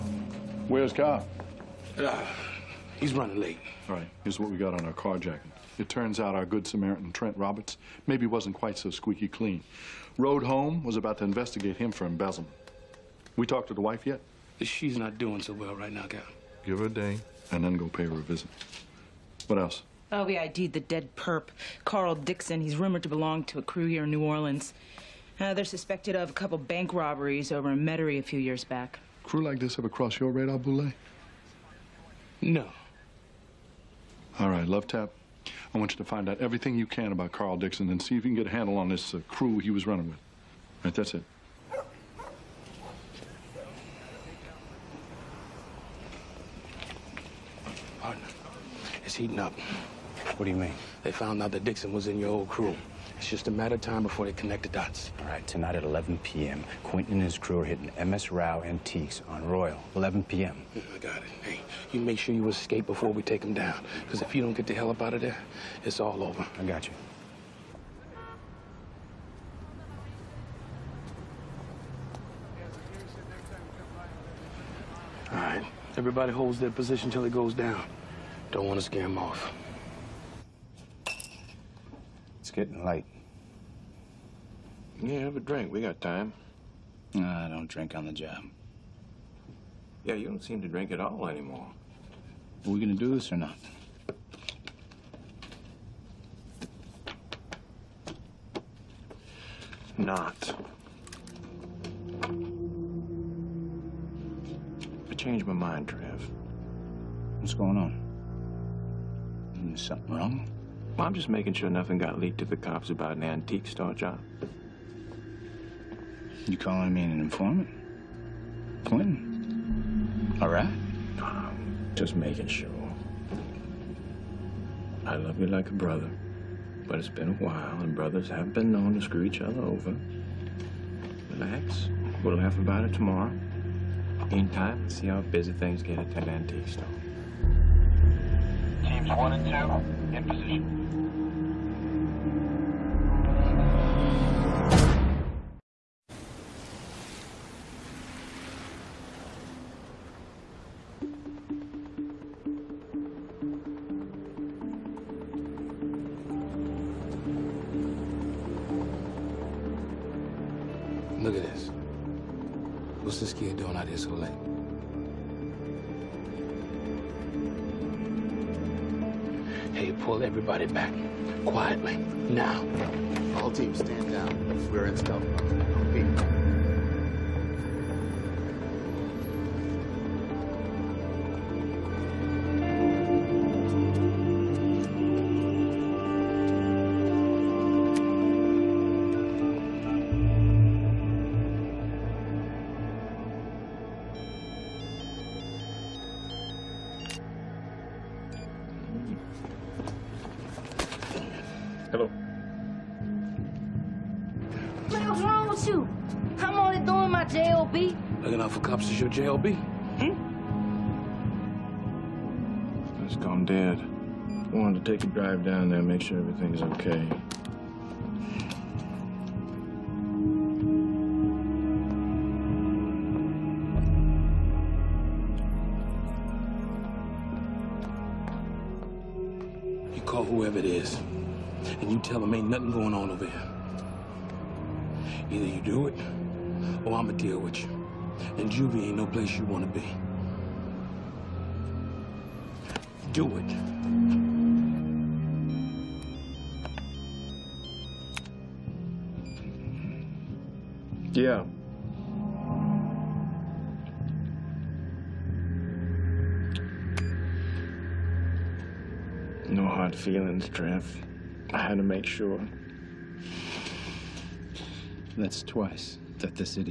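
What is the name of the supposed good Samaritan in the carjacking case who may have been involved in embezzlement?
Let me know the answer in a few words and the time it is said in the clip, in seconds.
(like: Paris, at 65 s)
Trent Roberts, at 7 s.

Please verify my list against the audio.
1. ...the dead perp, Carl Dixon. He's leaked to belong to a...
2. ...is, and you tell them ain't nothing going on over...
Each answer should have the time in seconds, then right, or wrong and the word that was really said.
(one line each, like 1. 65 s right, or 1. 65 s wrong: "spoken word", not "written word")
1. 20 s wrong: "rumored", not "leaked"
2. 230 s right.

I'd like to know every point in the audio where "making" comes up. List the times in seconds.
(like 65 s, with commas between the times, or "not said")
111 s, 122 s.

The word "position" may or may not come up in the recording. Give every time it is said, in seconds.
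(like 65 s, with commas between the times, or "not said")
76 s, 140 s.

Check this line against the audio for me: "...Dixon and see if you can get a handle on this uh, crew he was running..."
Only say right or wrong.
right.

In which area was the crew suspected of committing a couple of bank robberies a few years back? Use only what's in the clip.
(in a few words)
Metairie.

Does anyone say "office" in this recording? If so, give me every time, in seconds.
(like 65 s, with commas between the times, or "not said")
not said.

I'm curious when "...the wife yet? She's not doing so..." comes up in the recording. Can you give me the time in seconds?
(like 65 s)
13 s.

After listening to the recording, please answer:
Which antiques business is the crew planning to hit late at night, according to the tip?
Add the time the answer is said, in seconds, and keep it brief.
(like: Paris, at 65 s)
MS Rau Antiques, at 58 s.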